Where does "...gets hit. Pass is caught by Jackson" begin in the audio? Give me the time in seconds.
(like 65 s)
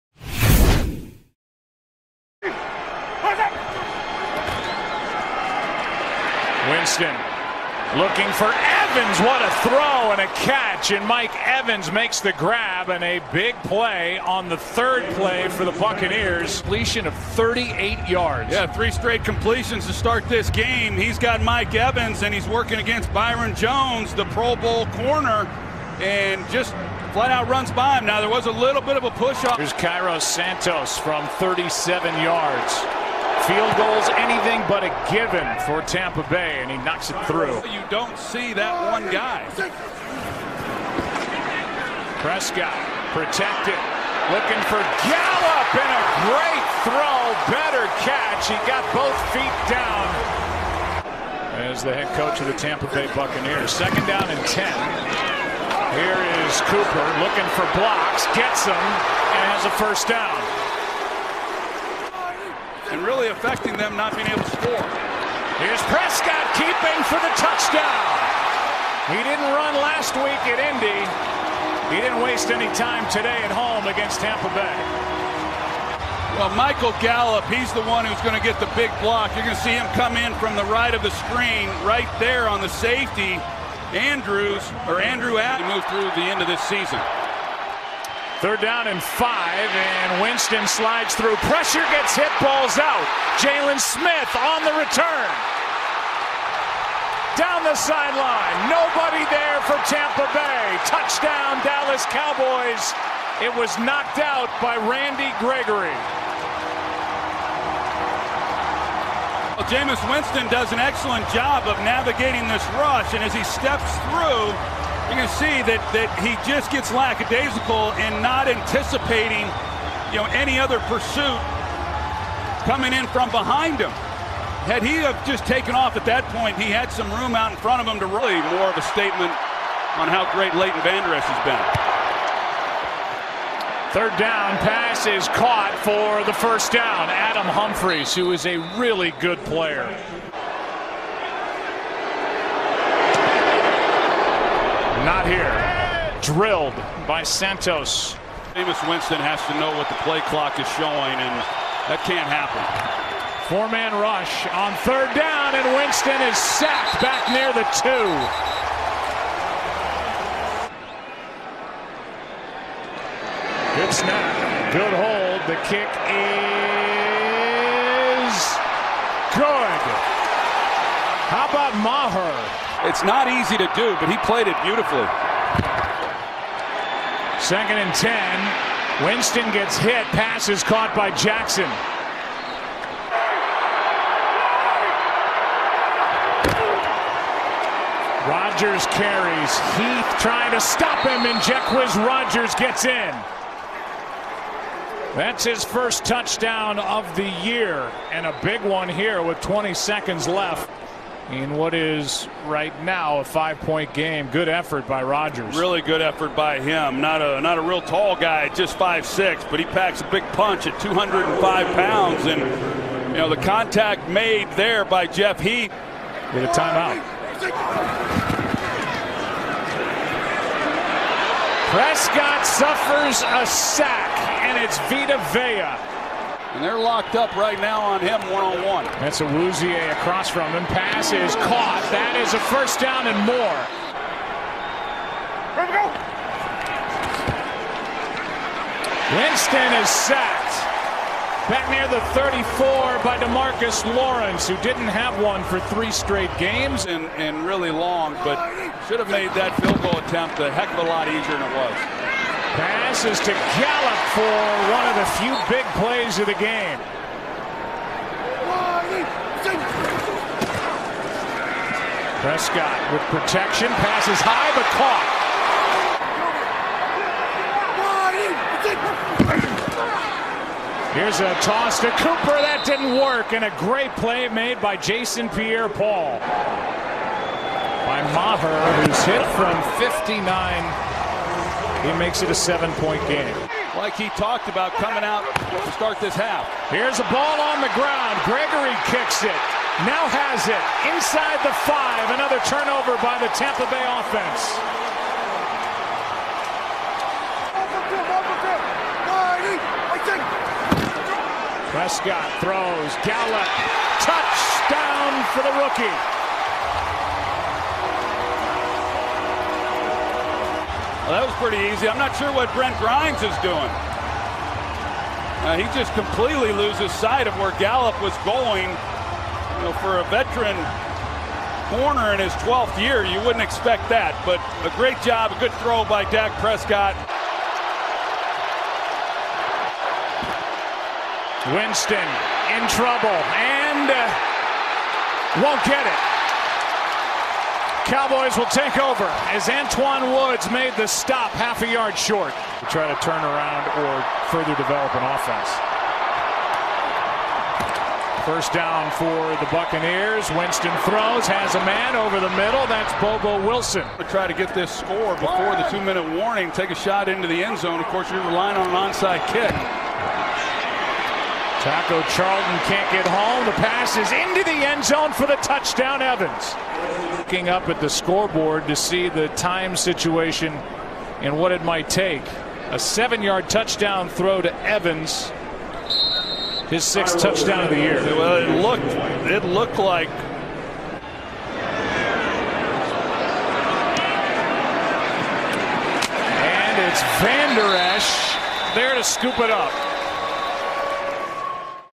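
179 s.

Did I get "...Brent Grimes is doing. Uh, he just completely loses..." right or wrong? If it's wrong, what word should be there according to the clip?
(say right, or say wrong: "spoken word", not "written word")
right.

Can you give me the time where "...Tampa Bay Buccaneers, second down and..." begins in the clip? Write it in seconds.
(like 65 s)
52 s.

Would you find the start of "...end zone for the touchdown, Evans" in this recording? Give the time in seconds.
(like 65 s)
364 s.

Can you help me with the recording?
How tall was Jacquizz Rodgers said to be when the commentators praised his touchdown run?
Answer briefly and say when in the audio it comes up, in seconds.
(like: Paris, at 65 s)
5 foot 6, at 208 s.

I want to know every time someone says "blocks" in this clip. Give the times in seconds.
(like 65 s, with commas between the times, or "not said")
57 s, 79 s.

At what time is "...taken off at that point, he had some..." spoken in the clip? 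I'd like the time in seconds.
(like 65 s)
125 s.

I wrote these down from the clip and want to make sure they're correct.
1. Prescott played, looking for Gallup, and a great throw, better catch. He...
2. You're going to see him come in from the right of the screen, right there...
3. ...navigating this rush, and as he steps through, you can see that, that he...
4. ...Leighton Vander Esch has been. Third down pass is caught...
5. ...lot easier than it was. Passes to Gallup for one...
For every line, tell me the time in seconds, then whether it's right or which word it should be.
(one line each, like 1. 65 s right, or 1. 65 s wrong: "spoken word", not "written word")
1. 42 s wrong: "protected", not "played"
2. 79 s right
3. 111 s right
4. 130 s right
5. 250 s right.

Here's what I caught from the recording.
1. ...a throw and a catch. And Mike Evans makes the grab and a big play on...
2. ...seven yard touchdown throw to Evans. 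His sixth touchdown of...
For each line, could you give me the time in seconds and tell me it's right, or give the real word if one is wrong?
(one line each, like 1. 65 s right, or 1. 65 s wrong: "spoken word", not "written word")
1. 9 s right
2. 372 s right.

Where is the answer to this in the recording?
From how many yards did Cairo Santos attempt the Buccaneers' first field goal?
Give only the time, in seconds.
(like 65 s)
31 s.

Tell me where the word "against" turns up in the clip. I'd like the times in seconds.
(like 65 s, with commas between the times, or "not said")
22 s, 73 s.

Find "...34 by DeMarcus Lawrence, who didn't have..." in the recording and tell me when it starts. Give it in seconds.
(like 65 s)
242 s.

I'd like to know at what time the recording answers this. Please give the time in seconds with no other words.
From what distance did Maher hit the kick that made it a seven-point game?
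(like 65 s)
279 s.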